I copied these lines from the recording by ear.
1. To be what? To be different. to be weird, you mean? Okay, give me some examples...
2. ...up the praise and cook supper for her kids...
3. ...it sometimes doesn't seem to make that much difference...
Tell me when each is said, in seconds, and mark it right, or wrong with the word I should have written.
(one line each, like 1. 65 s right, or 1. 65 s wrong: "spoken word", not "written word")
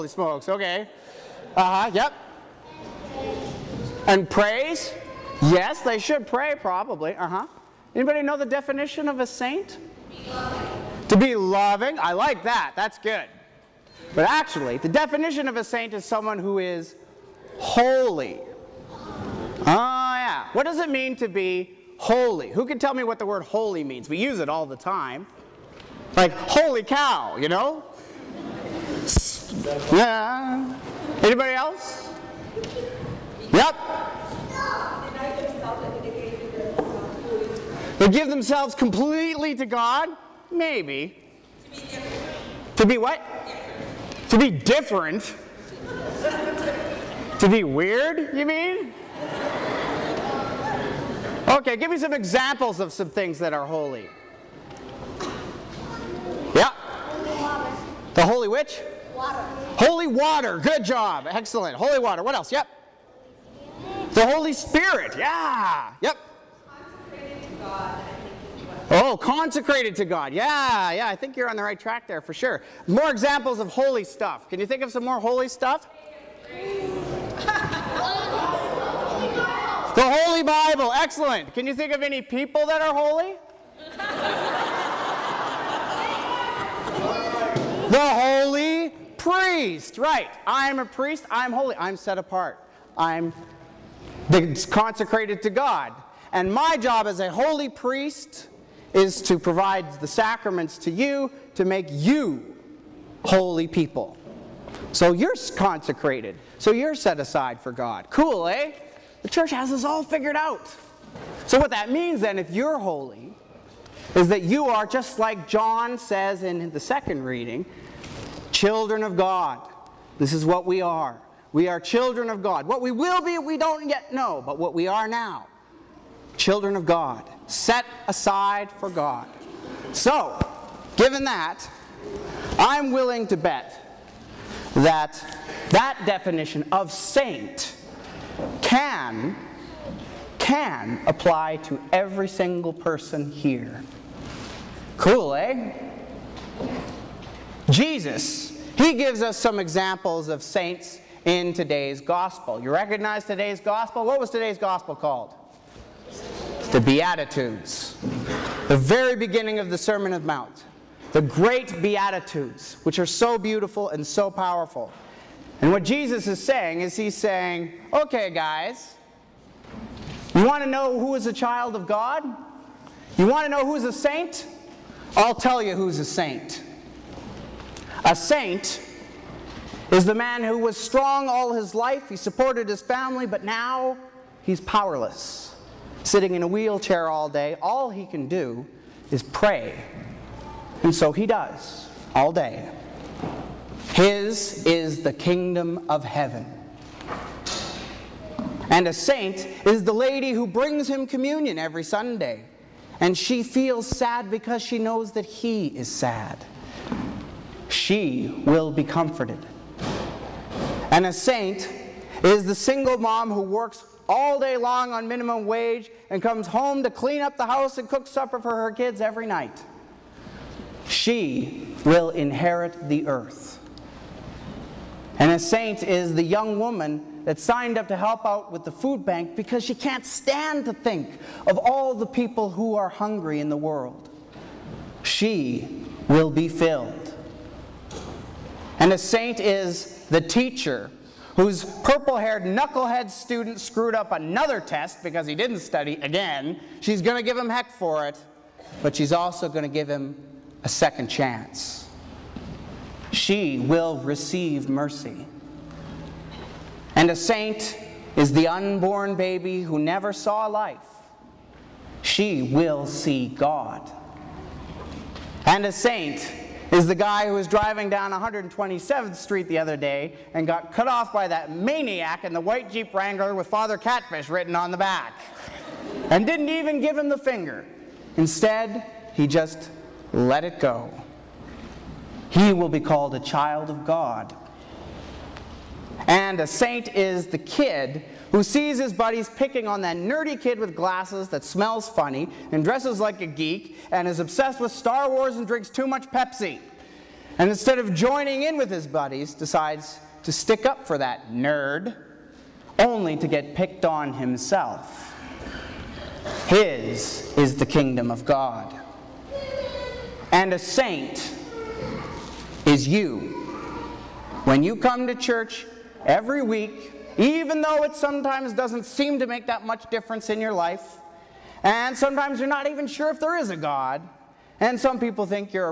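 1. 42 s right
2. 217 s wrong: "house", not "praise"
3. 317 s right.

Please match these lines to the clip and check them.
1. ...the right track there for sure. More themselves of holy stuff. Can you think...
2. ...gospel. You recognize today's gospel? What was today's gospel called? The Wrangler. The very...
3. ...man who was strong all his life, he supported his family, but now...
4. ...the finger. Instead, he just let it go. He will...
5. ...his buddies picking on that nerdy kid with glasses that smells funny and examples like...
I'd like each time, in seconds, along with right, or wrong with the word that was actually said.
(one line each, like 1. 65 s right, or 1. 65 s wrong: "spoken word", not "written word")
1. 71 s wrong: "examples", not "themselves"
2. 151 s wrong: "Beatitudes", not "Wrangler"
3. 180 s right
4. 277 s right
5. 288 s wrong: "dresses", not "examples".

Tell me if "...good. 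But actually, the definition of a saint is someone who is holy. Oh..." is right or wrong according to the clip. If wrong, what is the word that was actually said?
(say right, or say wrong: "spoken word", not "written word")
right.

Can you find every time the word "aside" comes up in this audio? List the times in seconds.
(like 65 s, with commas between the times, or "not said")
107 s, 128 s.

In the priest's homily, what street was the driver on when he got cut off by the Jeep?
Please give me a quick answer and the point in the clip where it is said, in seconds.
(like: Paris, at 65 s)
127th Street, at 268 s.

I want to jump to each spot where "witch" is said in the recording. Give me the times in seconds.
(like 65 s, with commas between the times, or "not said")
58 s.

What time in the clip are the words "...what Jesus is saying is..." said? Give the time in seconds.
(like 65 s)
165 s.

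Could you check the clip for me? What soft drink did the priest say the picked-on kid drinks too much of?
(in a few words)
Pepsi.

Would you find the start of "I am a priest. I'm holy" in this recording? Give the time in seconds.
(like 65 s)
90 s.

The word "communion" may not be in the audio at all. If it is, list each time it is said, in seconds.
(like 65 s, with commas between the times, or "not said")
201 s.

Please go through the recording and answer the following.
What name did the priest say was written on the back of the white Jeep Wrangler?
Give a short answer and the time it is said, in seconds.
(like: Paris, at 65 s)
Father Catfish, at 273 s.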